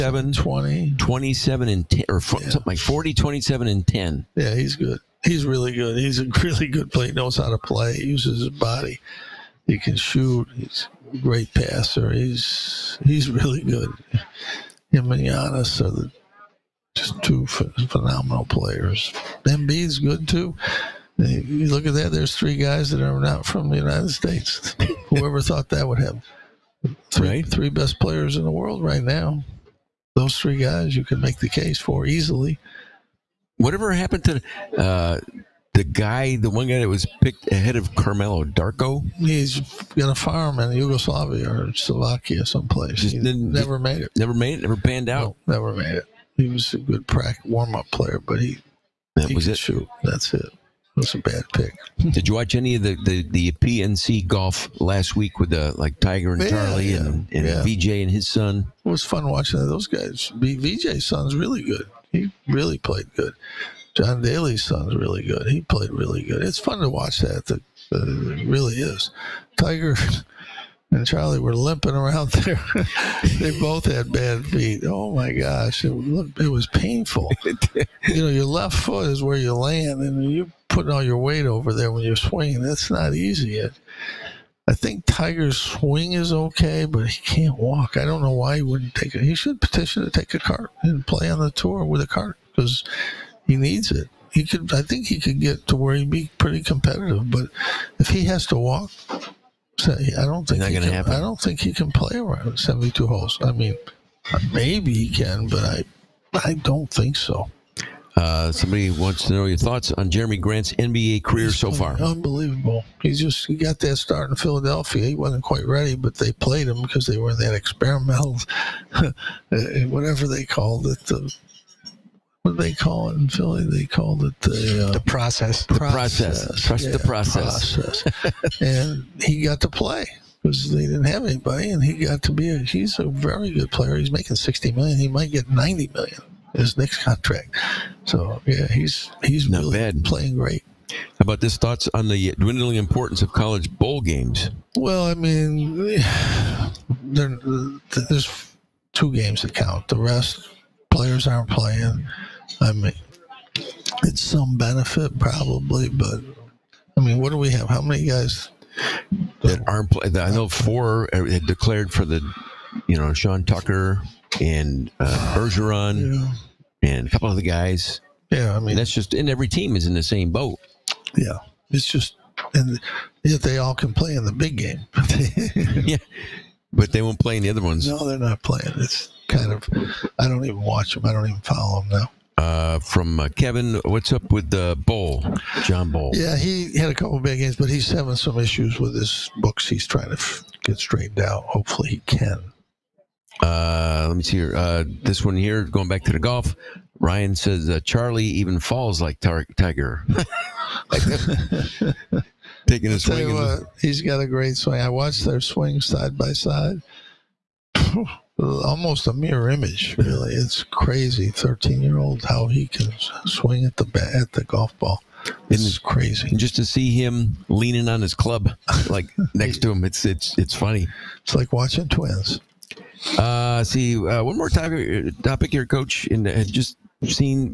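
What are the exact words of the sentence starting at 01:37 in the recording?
But if he has to walk, I don't think he can, happen.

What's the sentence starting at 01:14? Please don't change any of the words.
Oh my gosh, it, it was painful.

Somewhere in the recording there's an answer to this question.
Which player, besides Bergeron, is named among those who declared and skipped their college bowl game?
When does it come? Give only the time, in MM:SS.
02:43.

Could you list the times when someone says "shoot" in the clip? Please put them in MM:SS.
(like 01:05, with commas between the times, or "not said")
00:09, 00:49.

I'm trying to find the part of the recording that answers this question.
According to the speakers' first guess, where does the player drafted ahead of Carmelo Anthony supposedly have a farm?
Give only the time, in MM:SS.
00:40.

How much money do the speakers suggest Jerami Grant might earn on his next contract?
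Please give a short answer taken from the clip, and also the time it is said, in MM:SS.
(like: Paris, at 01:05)
90 million, at 02:15.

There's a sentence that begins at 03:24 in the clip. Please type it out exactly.
I watched their swing side by side.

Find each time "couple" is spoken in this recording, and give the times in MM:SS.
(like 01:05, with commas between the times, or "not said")
02:47, 03:06.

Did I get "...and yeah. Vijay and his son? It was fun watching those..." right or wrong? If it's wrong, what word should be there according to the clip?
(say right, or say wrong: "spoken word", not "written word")
right.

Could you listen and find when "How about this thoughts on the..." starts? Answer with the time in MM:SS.
02:20.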